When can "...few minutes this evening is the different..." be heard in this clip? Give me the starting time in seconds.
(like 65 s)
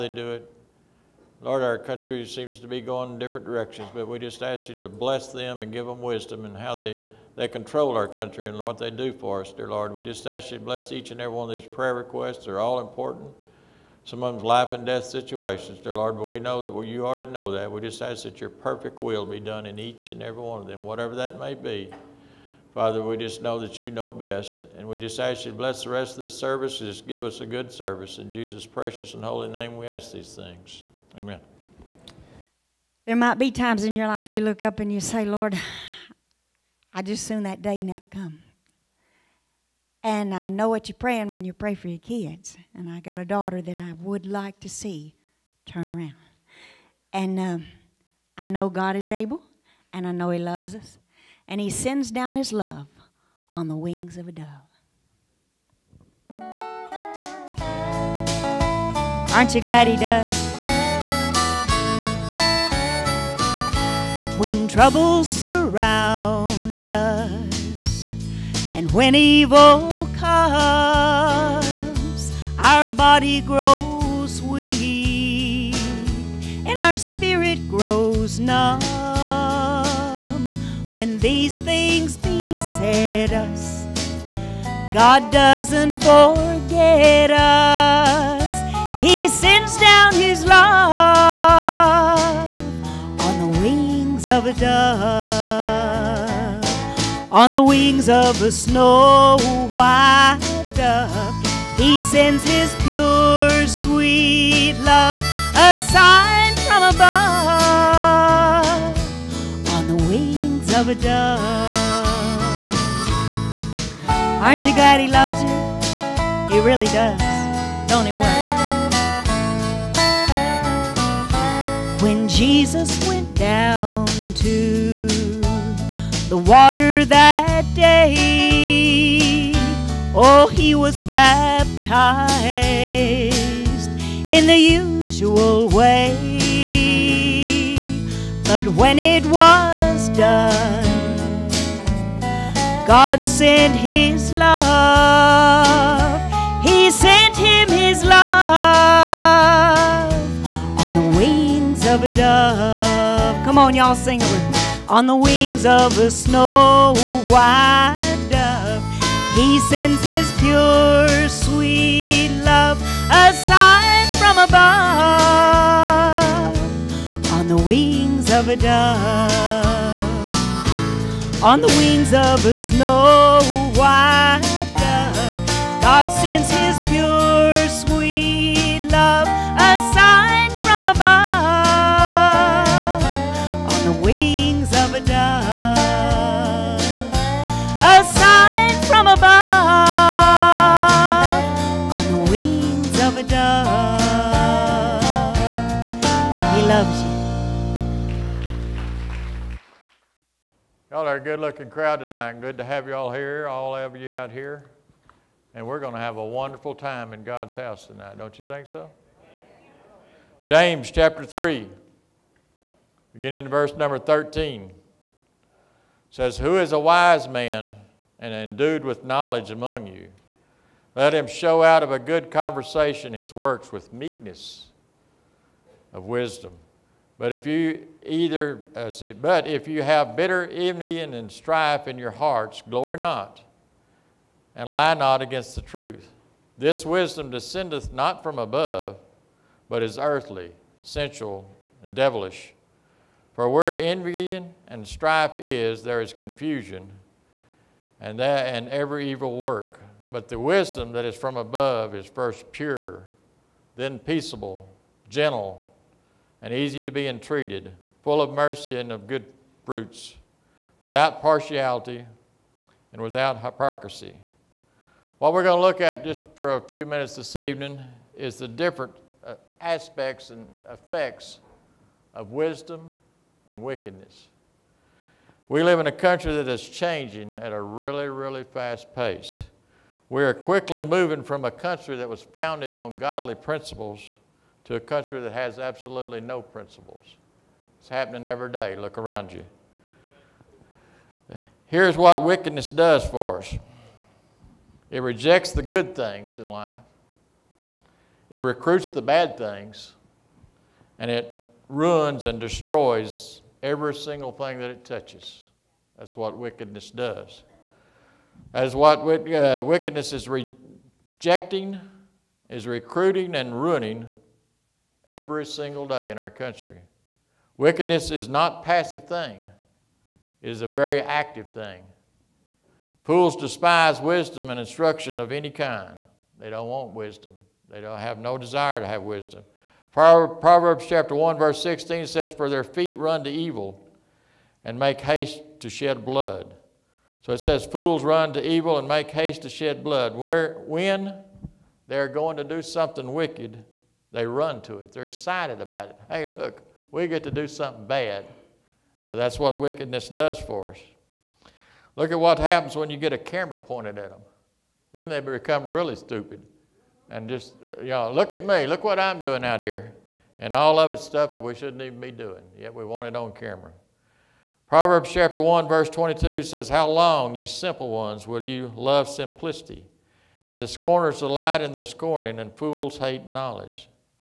266 s.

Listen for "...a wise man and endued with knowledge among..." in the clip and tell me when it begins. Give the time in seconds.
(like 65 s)
216 s.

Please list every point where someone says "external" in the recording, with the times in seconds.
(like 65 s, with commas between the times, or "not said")
not said.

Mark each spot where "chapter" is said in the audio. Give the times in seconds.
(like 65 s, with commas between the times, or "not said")
210 s, 330 s, 365 s.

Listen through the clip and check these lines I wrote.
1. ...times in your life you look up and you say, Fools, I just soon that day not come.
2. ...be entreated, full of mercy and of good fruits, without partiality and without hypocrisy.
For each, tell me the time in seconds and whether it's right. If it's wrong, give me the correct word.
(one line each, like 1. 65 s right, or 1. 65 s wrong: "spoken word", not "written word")
1. 33 s wrong: "Lord", not "Fools"
2. 256 s right.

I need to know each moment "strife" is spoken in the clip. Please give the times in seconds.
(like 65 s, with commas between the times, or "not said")
231 s, 244 s.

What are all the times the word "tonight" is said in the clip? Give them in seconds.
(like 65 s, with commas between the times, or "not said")
201 s, 207 s.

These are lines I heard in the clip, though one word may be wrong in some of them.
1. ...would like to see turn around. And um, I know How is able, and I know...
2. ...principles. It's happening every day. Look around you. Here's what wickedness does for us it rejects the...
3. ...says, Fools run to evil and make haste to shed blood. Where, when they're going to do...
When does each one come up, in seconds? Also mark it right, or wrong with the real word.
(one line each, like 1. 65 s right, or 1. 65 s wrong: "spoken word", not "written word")
1. 43 s wrong: "God", not "How"
2. 286 s right
3. 337 s right.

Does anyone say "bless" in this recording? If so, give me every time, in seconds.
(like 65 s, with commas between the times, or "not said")
4 s, 10 s, 25 s.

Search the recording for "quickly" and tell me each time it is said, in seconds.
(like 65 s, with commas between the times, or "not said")
280 s.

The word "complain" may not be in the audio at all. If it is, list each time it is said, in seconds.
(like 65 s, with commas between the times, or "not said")
not said.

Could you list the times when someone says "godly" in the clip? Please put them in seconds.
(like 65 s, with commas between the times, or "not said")
282 s.